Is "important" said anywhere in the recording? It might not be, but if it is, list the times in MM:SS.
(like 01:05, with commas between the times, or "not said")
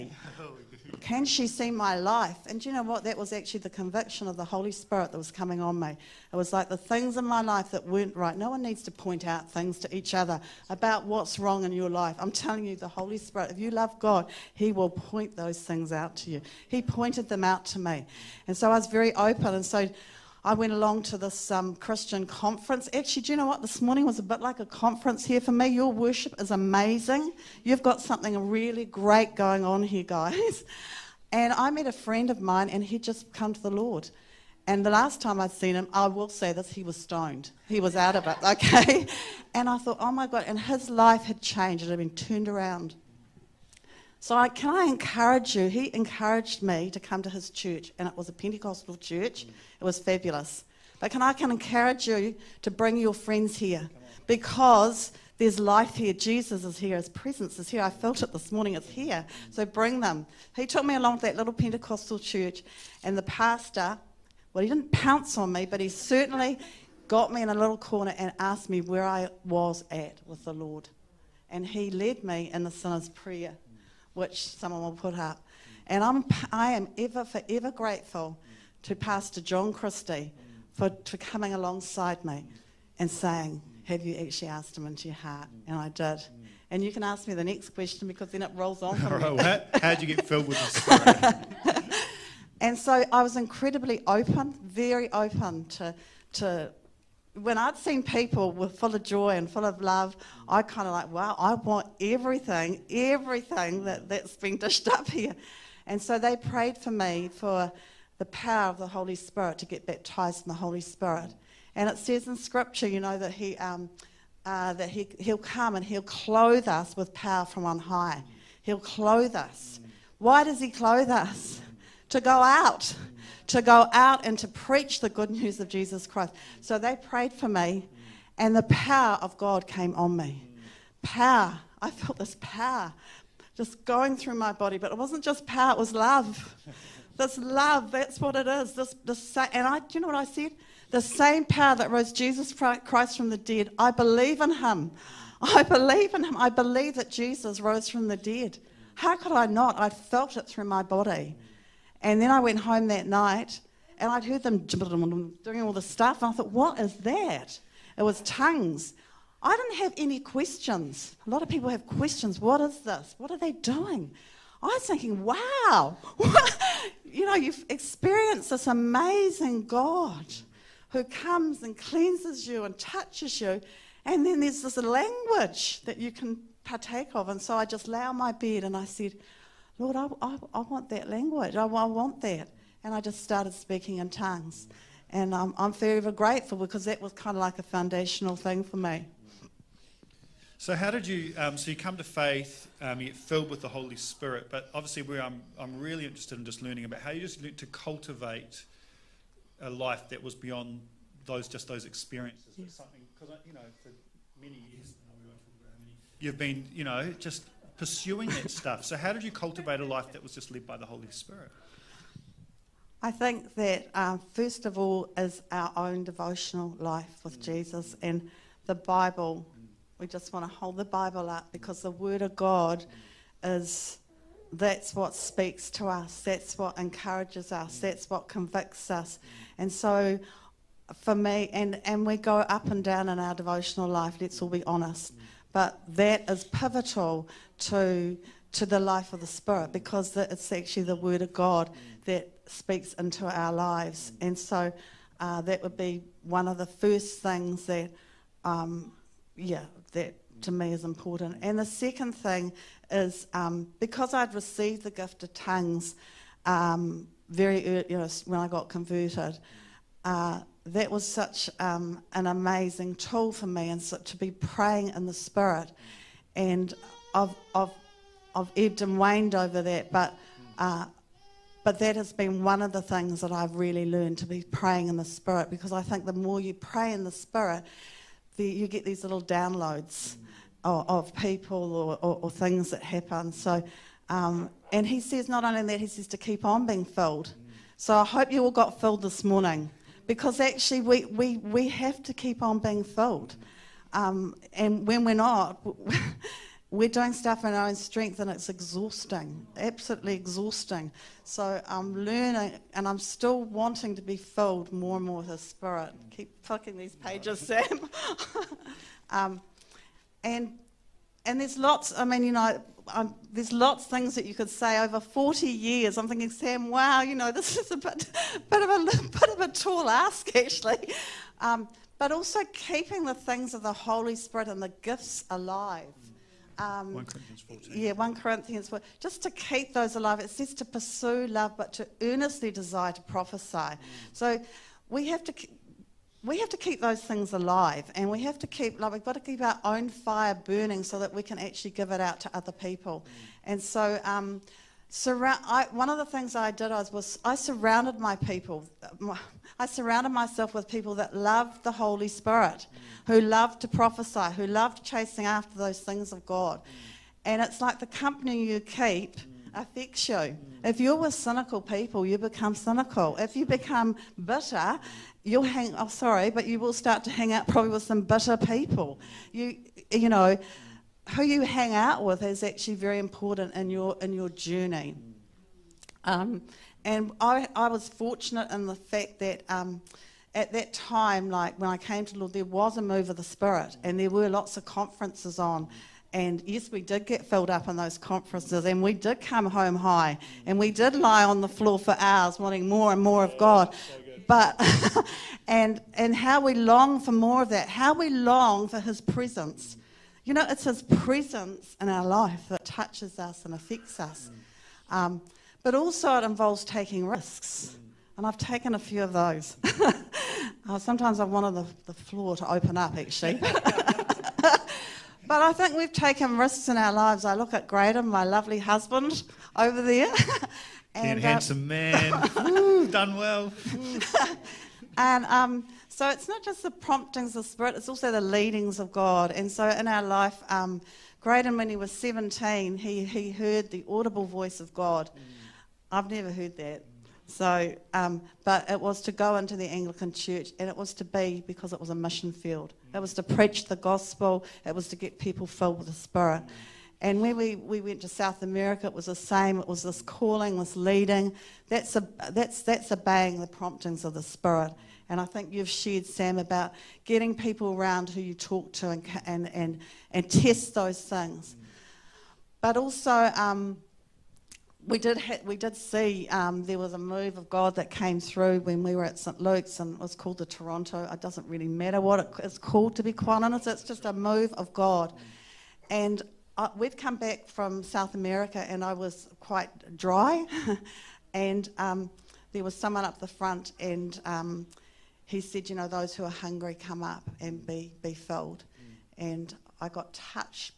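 04:10, 06:12.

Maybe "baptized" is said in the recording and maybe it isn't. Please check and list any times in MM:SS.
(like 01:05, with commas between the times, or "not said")
01:49.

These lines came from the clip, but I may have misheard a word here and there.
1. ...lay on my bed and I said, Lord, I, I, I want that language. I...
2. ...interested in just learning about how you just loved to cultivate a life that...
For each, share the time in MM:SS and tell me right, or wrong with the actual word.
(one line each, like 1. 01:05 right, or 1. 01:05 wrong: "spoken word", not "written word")
1. 02:57 right
2. 03:16 wrong: "learned", not "loved".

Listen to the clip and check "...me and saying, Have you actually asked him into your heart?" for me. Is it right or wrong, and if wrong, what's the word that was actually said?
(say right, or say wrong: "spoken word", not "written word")
right.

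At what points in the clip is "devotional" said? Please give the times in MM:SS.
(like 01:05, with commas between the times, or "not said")
03:36, 03:53.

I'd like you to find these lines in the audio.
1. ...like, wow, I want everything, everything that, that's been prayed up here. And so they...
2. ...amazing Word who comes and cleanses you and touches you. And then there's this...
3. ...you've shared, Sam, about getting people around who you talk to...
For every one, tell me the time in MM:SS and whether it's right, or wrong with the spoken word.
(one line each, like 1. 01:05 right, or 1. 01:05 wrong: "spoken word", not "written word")
1. 01:40 wrong: "dished", not "prayed"
2. 02:48 wrong: "God", not "Word"
3. 07:35 right.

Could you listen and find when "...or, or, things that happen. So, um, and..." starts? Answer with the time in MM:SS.
04:42.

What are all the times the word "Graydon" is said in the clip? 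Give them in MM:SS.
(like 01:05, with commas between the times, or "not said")
06:57, 07:11.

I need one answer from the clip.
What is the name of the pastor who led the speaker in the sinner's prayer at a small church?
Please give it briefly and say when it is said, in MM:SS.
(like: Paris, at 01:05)
John Christie, at 01:18.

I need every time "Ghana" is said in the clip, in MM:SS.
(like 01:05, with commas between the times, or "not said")
not said.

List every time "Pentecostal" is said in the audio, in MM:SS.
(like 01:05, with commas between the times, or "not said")
00:48, 01:01.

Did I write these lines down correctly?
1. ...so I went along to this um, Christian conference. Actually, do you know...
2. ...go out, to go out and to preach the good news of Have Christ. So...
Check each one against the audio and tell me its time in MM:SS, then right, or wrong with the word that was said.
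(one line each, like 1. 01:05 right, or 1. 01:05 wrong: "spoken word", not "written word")
1. 00:19 right
2. 02:02 wrong: "Jesus", not "Have".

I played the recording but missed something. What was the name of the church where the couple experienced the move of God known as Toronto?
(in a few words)
St Luke's.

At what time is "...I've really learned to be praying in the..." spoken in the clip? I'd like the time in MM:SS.
04:33.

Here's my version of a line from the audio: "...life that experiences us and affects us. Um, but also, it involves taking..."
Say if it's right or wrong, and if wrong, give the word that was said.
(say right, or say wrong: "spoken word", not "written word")
wrong: "touches", not "experiences".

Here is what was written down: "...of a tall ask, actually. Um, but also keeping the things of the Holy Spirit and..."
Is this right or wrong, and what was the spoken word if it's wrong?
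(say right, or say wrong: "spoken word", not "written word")
right.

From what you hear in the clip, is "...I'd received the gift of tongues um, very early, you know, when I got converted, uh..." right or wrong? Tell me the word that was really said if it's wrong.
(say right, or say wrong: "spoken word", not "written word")
right.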